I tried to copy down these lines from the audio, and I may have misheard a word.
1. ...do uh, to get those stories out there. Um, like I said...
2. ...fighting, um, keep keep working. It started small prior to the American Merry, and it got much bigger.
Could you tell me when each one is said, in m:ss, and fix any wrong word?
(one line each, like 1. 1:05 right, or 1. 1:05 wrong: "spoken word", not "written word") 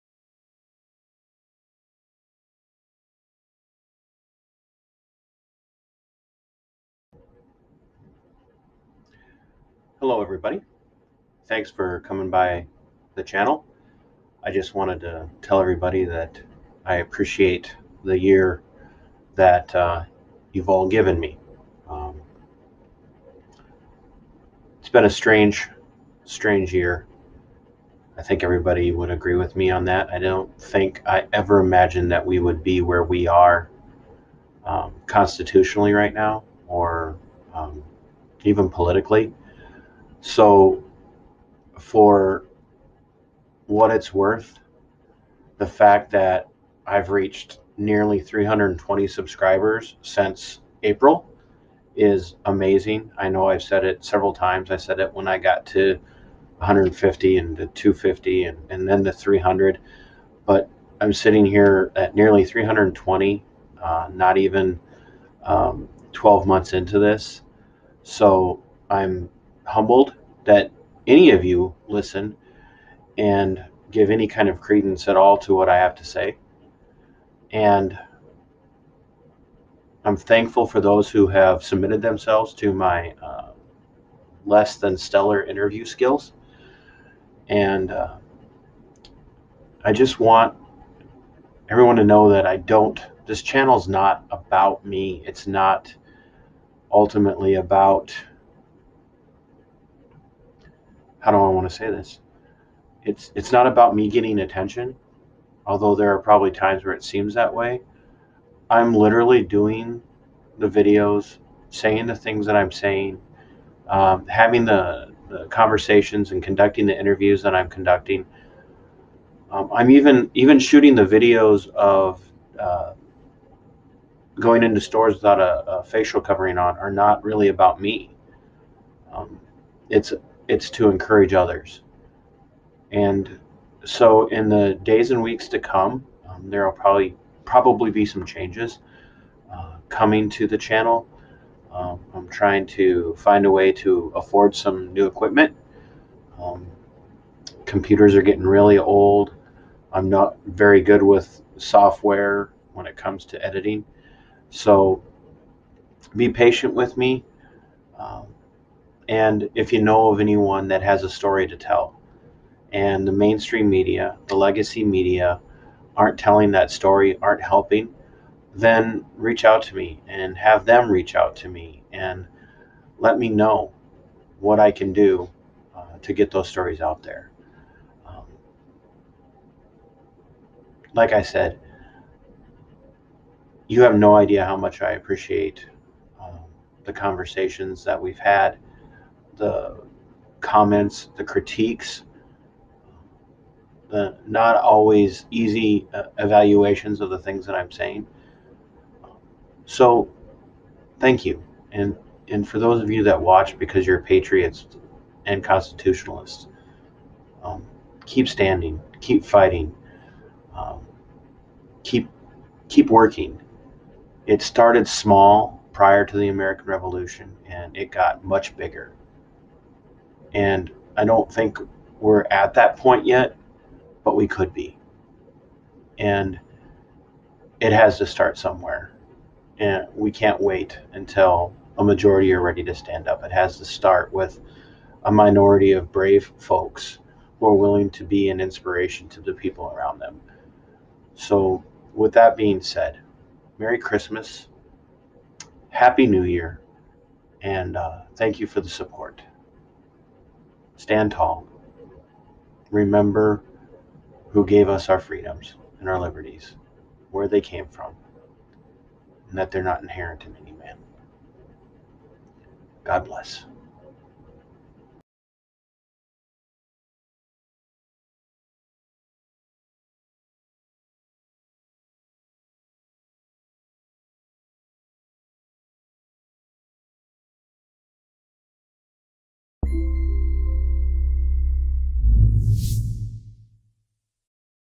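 1. 2:54 right
2. 3:29 wrong: "Revolution", not "Merry".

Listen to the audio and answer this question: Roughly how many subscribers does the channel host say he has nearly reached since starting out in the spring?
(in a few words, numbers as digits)
320.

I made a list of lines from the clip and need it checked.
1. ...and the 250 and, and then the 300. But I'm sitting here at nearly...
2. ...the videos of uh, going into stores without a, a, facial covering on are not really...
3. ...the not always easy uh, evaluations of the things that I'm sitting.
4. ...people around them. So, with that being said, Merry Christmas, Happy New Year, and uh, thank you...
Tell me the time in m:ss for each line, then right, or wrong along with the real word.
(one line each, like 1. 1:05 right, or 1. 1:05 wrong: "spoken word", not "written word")
1. 0:57 right
2. 2:00 right
3. 3:13 wrong: "saying", not "sitting"
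4. 3:59 right.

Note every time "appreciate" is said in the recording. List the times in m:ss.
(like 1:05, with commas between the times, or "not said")
0:16, 3:04.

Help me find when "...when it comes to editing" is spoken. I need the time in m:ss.
2:32.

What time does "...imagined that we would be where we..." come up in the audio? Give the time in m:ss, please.
0:31.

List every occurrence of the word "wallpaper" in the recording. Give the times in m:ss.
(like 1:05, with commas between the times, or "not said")
not said.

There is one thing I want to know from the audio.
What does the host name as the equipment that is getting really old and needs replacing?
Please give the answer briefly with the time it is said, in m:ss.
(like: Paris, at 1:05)
Computers, at 2:27.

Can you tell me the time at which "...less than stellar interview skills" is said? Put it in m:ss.
1:24.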